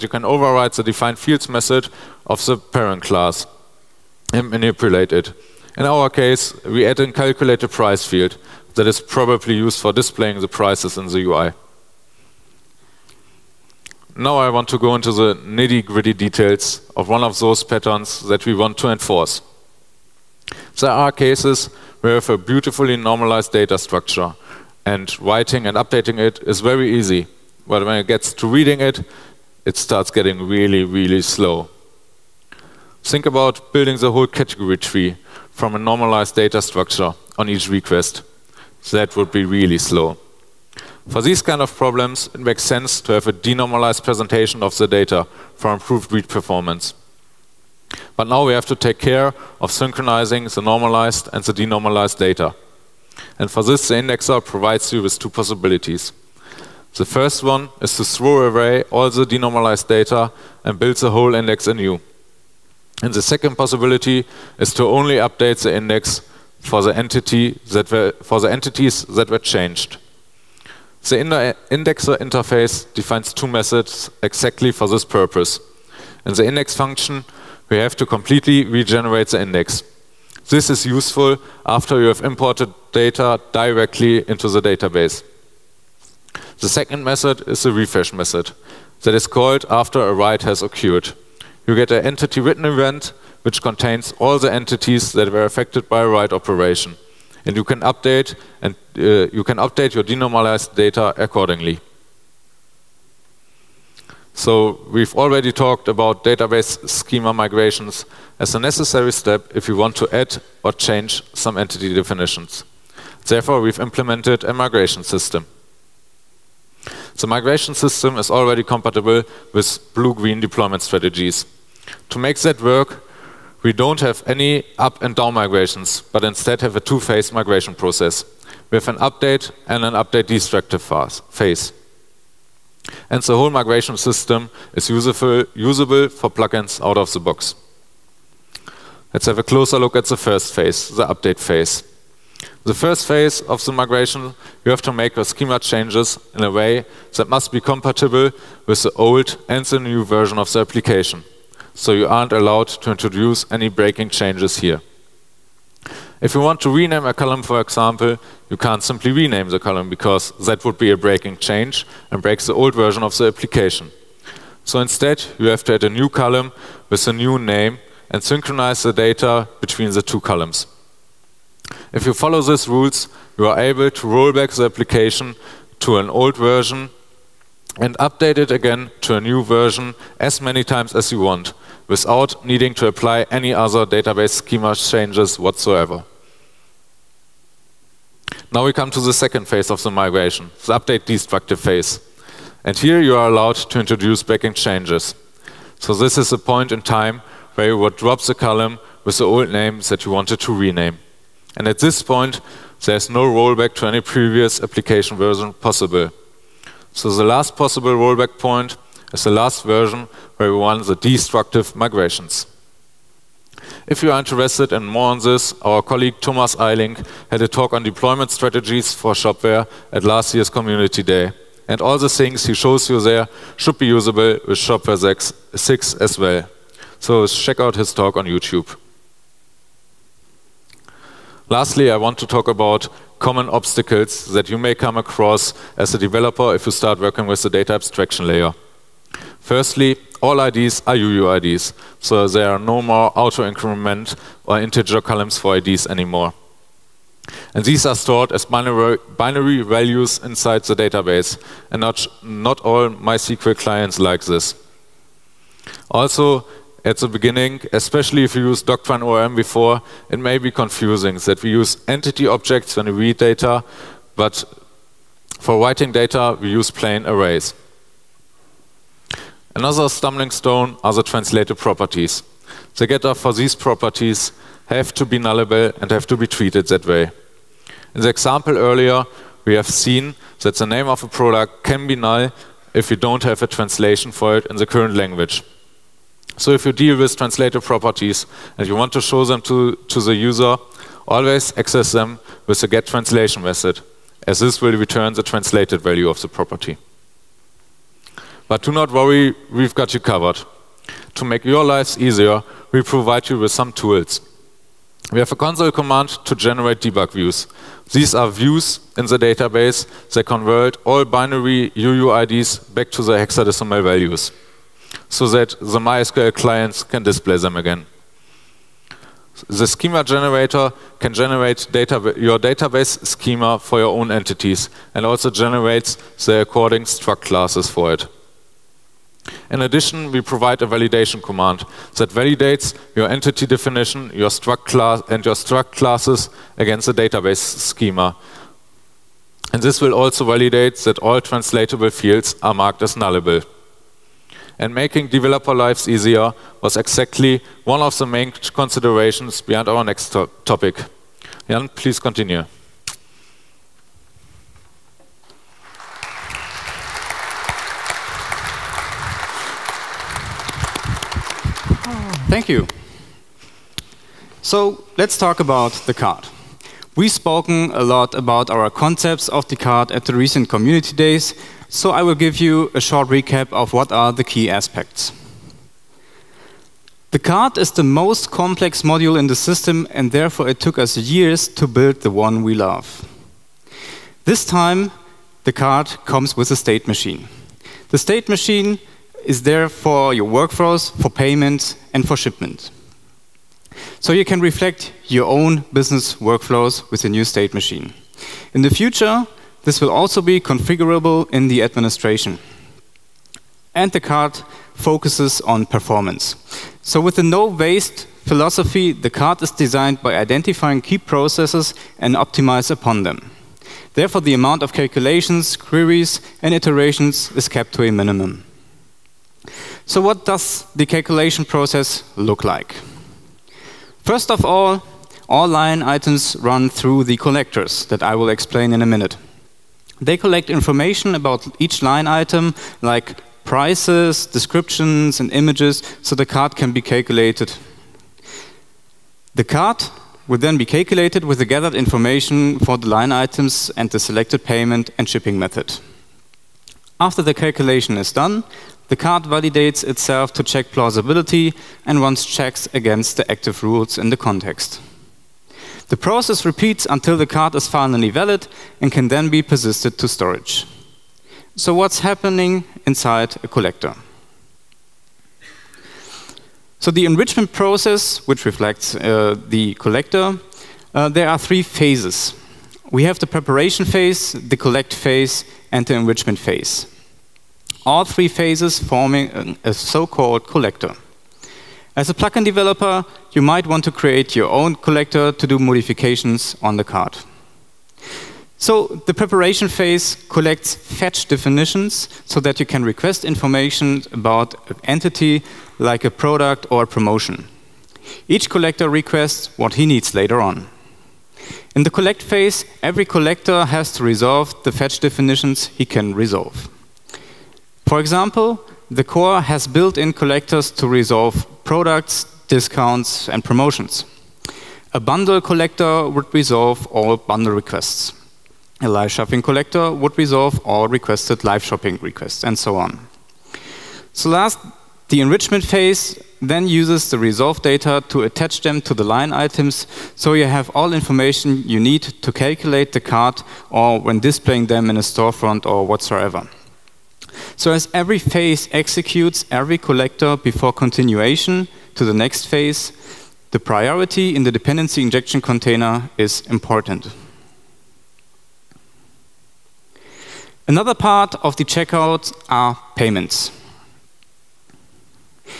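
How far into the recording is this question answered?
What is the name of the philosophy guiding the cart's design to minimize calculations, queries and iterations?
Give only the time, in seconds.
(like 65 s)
407 s.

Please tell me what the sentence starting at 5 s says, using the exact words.
In our case, we add in calculated price field that is probably used for displaying the prices in the UI.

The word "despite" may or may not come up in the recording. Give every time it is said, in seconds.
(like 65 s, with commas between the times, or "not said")
not said.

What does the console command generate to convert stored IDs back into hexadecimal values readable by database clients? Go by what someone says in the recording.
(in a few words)
debug views.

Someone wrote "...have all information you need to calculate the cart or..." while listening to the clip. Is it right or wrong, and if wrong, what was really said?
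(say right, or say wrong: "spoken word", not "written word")
right.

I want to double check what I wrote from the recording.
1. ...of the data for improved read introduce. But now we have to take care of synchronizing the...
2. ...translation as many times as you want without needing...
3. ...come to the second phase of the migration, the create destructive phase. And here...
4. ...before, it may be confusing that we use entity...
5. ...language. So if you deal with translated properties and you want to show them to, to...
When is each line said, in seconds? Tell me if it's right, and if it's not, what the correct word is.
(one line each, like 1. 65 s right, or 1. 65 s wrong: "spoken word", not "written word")
1. 44 s wrong: "performance", not "introduce"
2. 179 s wrong: "version", not "translation"
3. 188 s wrong: "update", not "create"
4. 259 s right
5. 284 s right.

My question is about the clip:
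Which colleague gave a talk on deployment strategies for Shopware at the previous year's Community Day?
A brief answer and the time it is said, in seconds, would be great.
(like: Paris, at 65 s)
Thomas Eiling, at 216 s.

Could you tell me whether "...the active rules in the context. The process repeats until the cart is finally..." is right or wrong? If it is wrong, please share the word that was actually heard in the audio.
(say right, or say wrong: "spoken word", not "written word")
right.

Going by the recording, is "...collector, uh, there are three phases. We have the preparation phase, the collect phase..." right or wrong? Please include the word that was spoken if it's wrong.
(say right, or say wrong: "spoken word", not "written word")
right.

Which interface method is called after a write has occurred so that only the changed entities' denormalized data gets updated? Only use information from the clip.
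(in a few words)
refresh.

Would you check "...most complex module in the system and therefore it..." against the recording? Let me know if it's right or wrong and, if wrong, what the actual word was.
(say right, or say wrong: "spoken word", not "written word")
right.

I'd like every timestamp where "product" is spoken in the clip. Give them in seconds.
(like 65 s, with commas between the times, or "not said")
281 s, 496 s, 511 s.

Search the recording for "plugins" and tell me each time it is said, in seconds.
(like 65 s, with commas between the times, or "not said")
136 s, 482 s.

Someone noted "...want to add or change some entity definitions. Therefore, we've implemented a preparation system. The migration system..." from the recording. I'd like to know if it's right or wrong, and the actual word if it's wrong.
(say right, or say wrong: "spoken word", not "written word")
wrong: "migration", not "preparation".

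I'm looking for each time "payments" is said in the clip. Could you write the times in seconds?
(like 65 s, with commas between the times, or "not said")
391 s, 444 s, 552 s.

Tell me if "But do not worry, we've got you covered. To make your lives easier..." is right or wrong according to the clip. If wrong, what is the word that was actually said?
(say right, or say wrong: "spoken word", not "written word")
right.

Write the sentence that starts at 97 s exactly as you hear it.
And you can update and uh, you can update your denormalized data accordingly.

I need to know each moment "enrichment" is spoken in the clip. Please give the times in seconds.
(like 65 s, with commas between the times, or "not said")
467 s, 475 s, 525 s.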